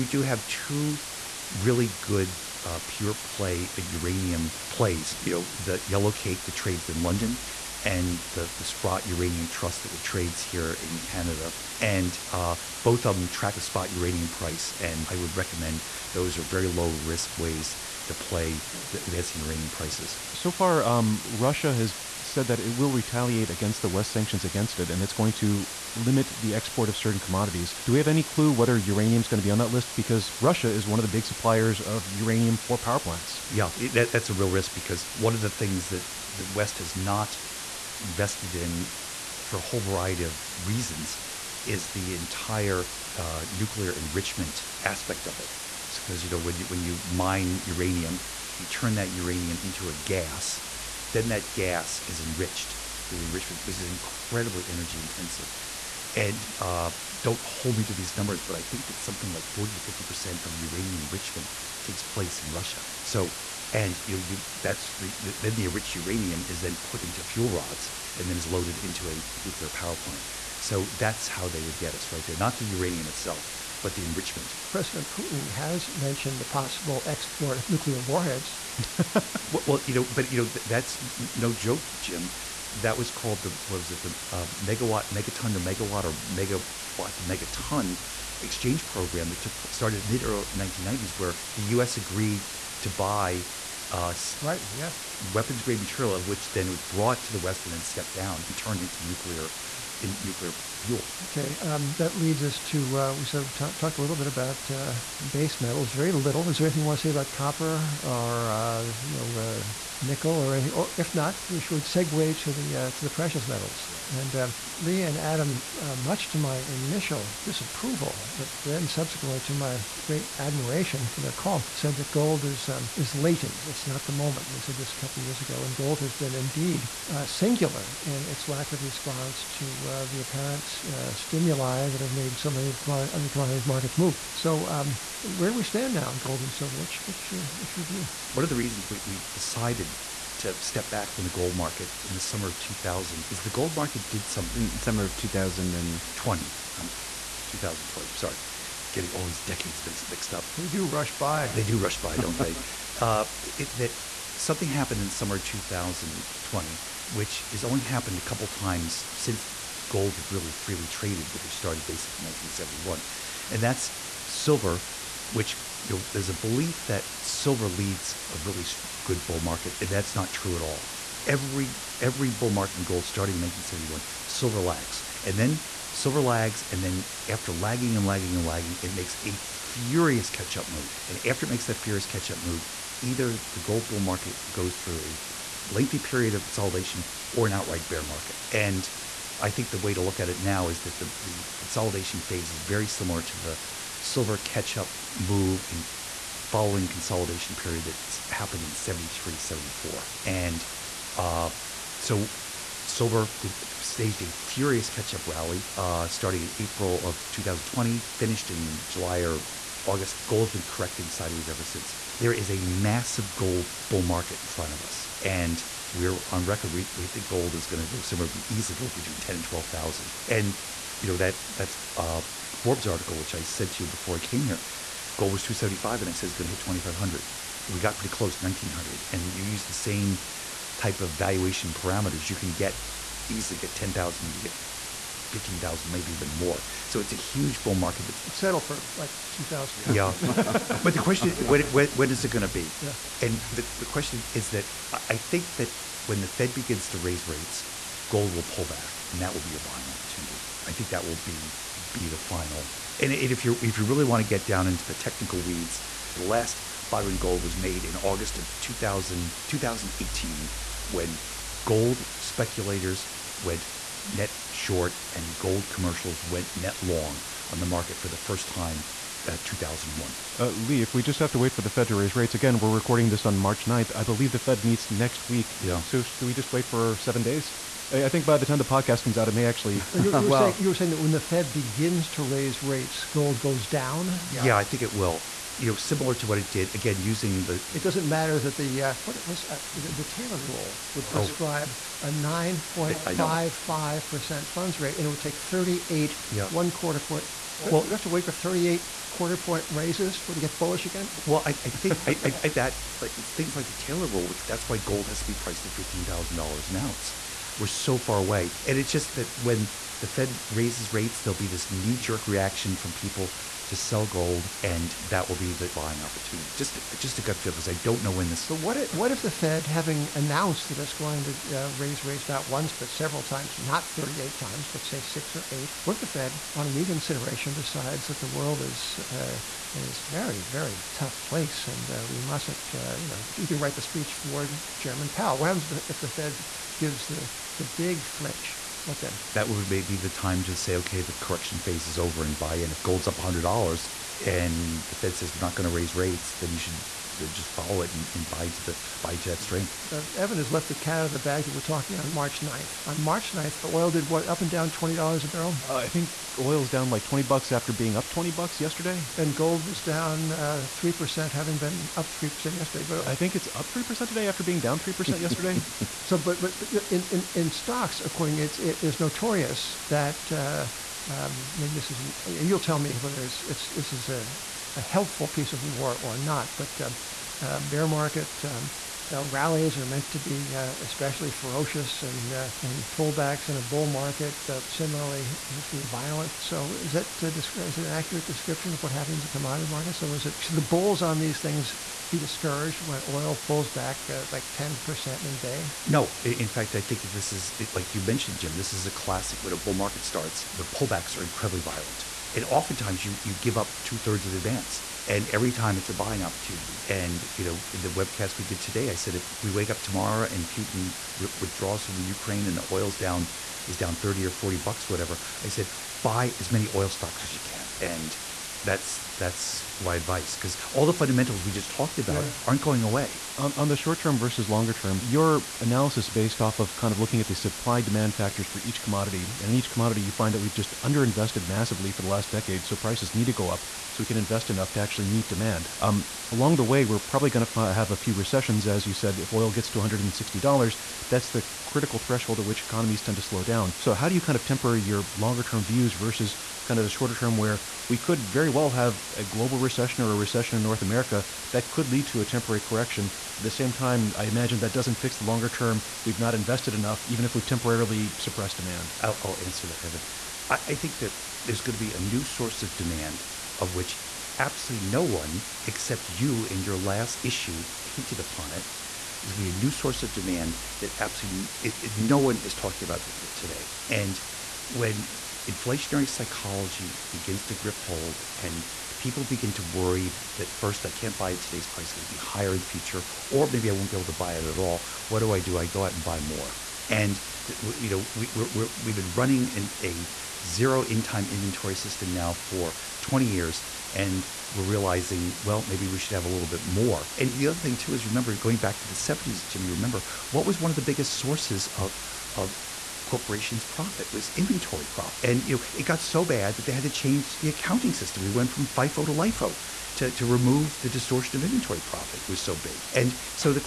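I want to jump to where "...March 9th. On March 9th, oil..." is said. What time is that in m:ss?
5:52.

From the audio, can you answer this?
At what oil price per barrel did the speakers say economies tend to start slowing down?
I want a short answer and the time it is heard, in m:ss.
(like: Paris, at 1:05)
$160, at 7:19.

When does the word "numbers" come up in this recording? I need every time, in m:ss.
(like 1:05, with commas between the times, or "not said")
0:58.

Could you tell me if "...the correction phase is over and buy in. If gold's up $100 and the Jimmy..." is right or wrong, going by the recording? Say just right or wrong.
wrong.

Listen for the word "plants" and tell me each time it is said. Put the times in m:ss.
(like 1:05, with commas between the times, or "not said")
0:32, 1:09.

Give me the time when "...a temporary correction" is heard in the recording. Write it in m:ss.
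7:32.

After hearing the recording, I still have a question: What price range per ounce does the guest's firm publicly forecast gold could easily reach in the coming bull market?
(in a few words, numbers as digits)
10,000 to 12,000.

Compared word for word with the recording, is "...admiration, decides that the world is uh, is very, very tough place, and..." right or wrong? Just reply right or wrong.
wrong.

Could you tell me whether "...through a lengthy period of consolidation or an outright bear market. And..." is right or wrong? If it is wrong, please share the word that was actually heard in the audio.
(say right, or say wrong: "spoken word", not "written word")
right.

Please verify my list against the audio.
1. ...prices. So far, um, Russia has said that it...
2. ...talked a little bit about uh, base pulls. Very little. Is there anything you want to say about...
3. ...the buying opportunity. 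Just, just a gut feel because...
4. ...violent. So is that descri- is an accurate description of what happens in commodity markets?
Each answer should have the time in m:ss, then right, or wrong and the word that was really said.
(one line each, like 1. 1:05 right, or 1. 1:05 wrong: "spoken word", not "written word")
1. 0:19 right
2. 1:43 wrong: "metals", not "pulls"
3. 5:15 right
4. 6:25 right.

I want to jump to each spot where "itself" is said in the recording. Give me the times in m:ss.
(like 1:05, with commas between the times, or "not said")
1:13.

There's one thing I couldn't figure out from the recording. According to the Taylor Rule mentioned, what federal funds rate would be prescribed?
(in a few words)
9.55 percent.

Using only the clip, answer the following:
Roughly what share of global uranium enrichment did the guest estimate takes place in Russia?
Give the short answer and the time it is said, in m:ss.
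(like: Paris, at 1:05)
40 to 50 percent, at 0:59.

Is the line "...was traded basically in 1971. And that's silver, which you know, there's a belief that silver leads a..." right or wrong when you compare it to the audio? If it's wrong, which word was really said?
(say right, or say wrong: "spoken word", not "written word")
wrong: "started", not "traded".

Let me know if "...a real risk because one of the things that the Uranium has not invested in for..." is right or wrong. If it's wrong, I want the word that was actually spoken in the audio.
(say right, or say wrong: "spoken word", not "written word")
wrong: "West", not "Uranium".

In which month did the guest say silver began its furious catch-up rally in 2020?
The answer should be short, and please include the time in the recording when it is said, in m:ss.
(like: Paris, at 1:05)
April, at 3:26.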